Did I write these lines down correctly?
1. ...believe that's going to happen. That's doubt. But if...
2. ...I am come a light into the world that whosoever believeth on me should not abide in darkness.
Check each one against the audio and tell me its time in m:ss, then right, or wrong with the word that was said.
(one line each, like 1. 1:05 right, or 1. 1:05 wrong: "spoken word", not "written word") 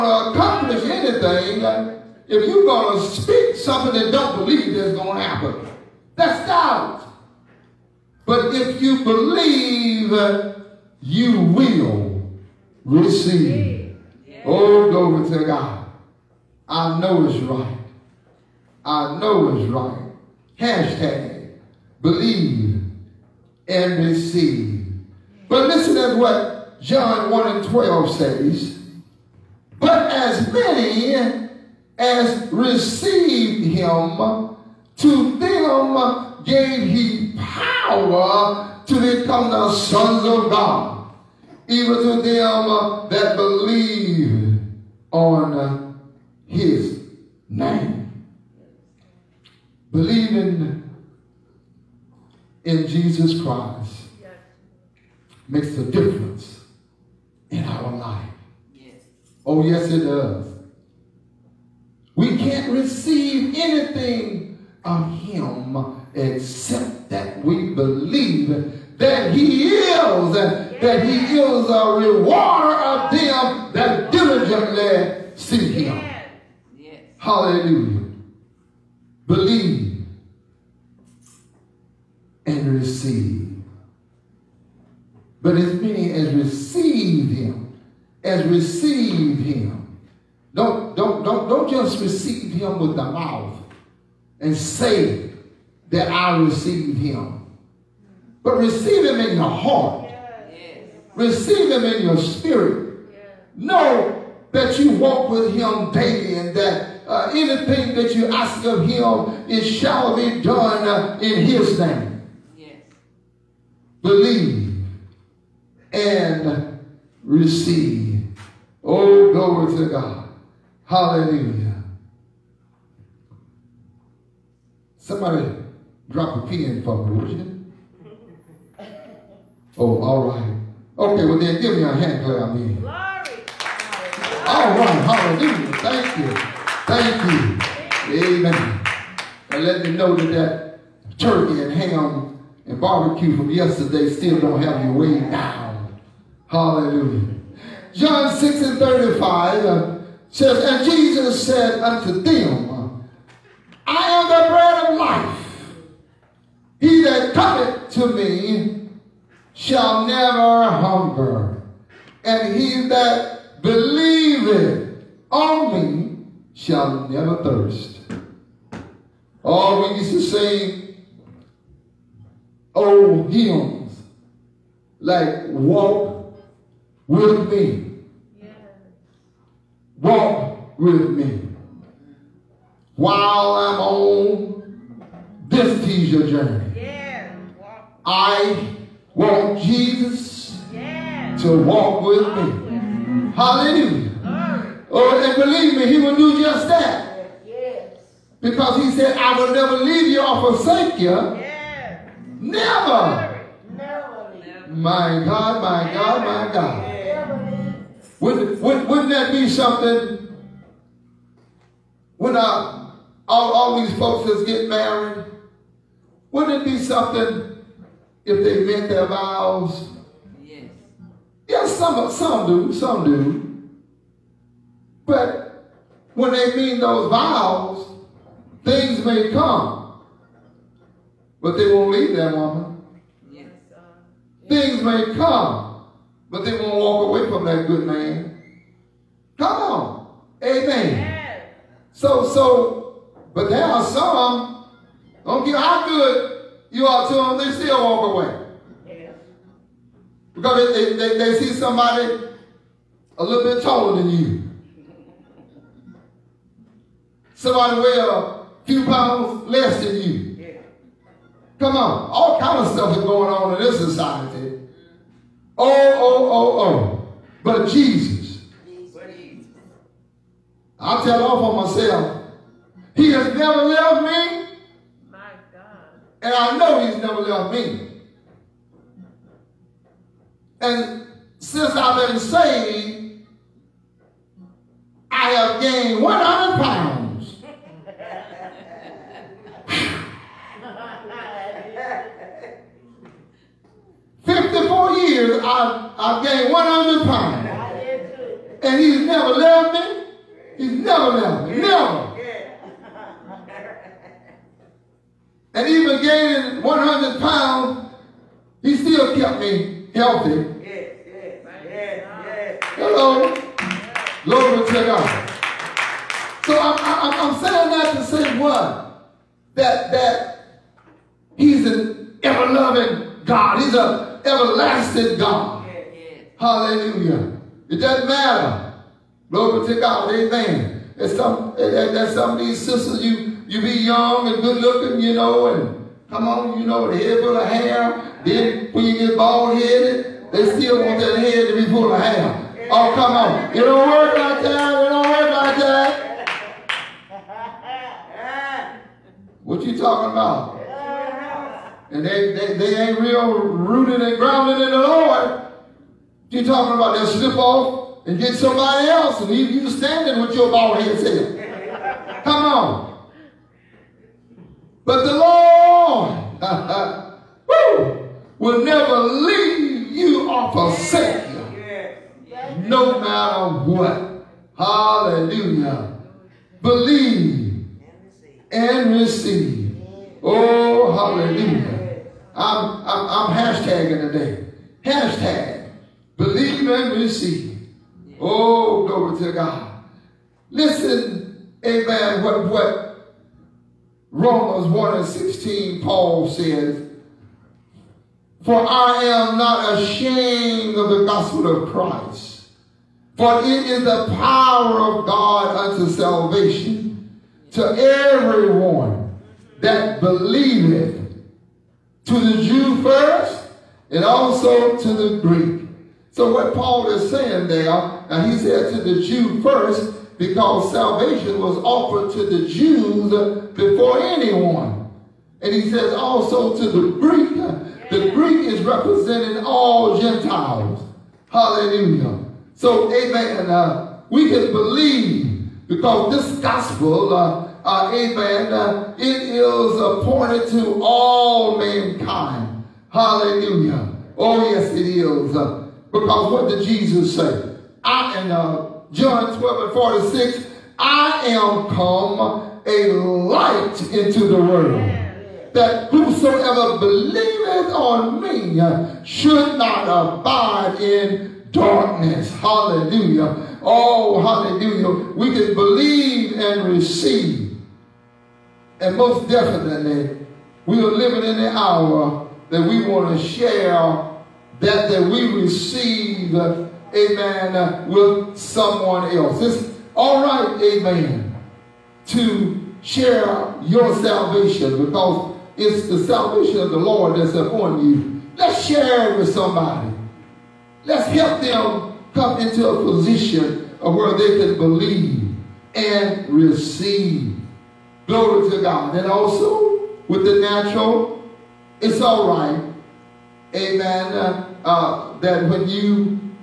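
1. 0:04 right
2. 7:30 right.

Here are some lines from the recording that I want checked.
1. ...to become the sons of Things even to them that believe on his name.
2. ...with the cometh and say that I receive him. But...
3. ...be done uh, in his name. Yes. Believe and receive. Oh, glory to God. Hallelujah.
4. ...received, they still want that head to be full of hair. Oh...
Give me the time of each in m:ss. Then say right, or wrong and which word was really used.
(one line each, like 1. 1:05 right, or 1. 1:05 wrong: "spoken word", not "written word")
1. 0:38 wrong: "God", not "Things"
2. 1:32 wrong: "mouth", not "cometh"
3. 1:50 right
4. 5:39 wrong: "headed", not "received".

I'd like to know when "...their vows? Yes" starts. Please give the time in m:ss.
3:38.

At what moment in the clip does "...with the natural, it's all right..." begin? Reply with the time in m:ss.
8:20.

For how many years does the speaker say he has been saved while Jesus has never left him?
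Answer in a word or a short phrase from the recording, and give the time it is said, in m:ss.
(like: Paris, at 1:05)
54, at 4:54.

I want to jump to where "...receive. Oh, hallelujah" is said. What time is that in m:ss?
6:18.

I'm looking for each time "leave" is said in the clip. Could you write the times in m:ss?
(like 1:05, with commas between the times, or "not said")
3:19, 3:51, 5:59, 6:08.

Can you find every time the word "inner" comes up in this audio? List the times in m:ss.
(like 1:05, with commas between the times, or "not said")
not said.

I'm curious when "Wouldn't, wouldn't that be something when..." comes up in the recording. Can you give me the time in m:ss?
3:28.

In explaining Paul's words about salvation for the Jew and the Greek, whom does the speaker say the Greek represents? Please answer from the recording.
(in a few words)
all Gentiles.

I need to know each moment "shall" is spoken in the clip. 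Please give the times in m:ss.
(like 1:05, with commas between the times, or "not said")
1:49, 2:39, 2:46.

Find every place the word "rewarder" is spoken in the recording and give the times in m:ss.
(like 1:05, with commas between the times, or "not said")
1:11.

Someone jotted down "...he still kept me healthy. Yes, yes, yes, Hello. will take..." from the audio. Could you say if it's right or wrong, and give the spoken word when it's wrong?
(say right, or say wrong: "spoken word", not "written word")
right.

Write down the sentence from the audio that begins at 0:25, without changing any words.
But listen to what John 1 and 12 says.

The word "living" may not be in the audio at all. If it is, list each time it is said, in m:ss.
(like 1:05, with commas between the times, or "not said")
7:50.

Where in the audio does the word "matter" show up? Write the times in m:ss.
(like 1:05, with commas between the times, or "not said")
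5:28, 6:12.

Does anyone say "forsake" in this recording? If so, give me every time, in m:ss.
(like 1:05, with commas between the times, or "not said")
3:20, 6:10.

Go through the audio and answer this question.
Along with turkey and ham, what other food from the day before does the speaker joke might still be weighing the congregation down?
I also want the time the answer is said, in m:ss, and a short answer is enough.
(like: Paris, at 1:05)
barbecue, at 2:22.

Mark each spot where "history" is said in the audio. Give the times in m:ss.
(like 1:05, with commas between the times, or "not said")
not said.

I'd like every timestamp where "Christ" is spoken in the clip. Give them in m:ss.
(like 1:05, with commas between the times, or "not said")
0:53, 6:41.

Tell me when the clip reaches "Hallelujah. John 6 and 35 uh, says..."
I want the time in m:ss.
2:26.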